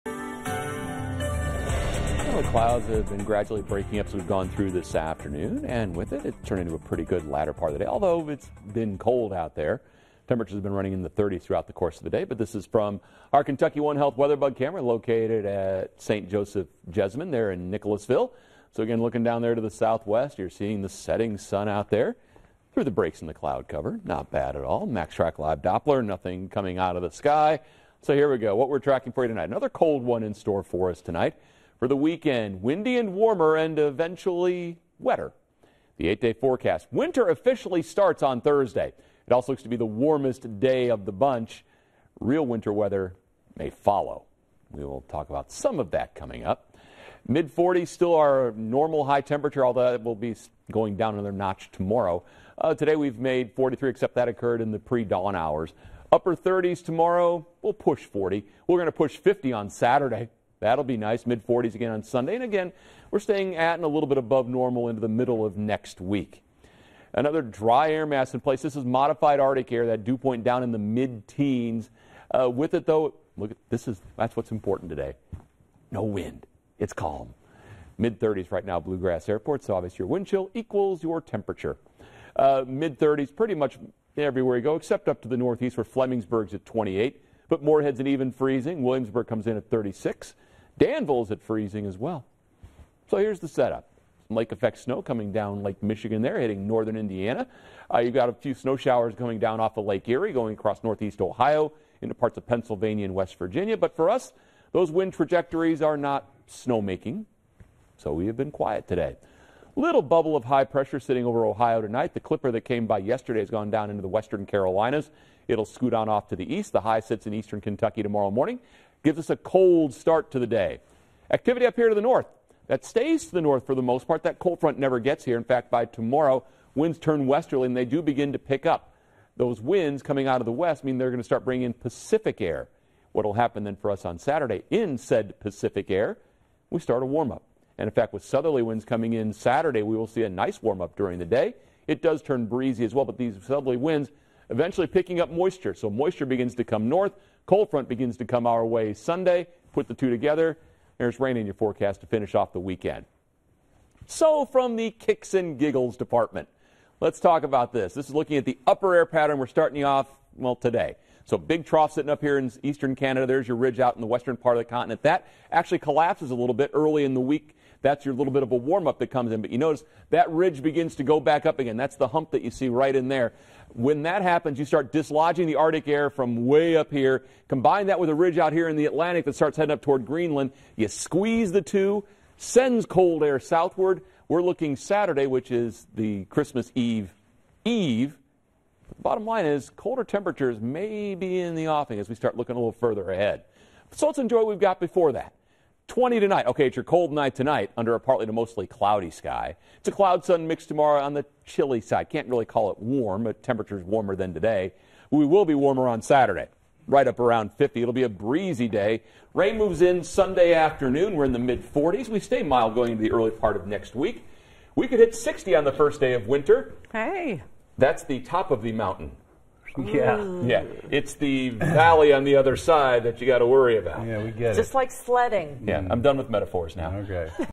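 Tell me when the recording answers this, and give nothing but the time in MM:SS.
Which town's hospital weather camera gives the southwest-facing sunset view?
00:17.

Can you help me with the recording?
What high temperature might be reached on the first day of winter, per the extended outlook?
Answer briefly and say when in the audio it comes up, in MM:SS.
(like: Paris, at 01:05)
60, at 03:35.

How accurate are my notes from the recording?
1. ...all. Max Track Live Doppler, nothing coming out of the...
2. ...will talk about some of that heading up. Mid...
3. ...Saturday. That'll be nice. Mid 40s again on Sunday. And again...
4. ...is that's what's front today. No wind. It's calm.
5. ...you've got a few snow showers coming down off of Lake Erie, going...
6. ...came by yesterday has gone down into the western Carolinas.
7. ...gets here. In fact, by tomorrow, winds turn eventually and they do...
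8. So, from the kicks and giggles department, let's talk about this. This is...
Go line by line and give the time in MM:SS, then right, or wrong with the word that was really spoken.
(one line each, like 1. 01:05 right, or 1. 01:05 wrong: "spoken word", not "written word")
1. 00:24 right
2. 00:44 wrong: "coming", not "heading"
3. 00:59 right
4. 01:13 wrong: "important", not "front"
5. 01:37 right
6. 01:52 right
7. 02:04 wrong: "westerly", not "eventually"
8. 02:34 right.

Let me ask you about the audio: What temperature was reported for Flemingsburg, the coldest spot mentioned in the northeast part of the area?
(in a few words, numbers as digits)
28.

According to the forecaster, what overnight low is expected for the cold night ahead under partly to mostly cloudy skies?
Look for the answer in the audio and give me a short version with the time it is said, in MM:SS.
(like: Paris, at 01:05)
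20, at 03:15.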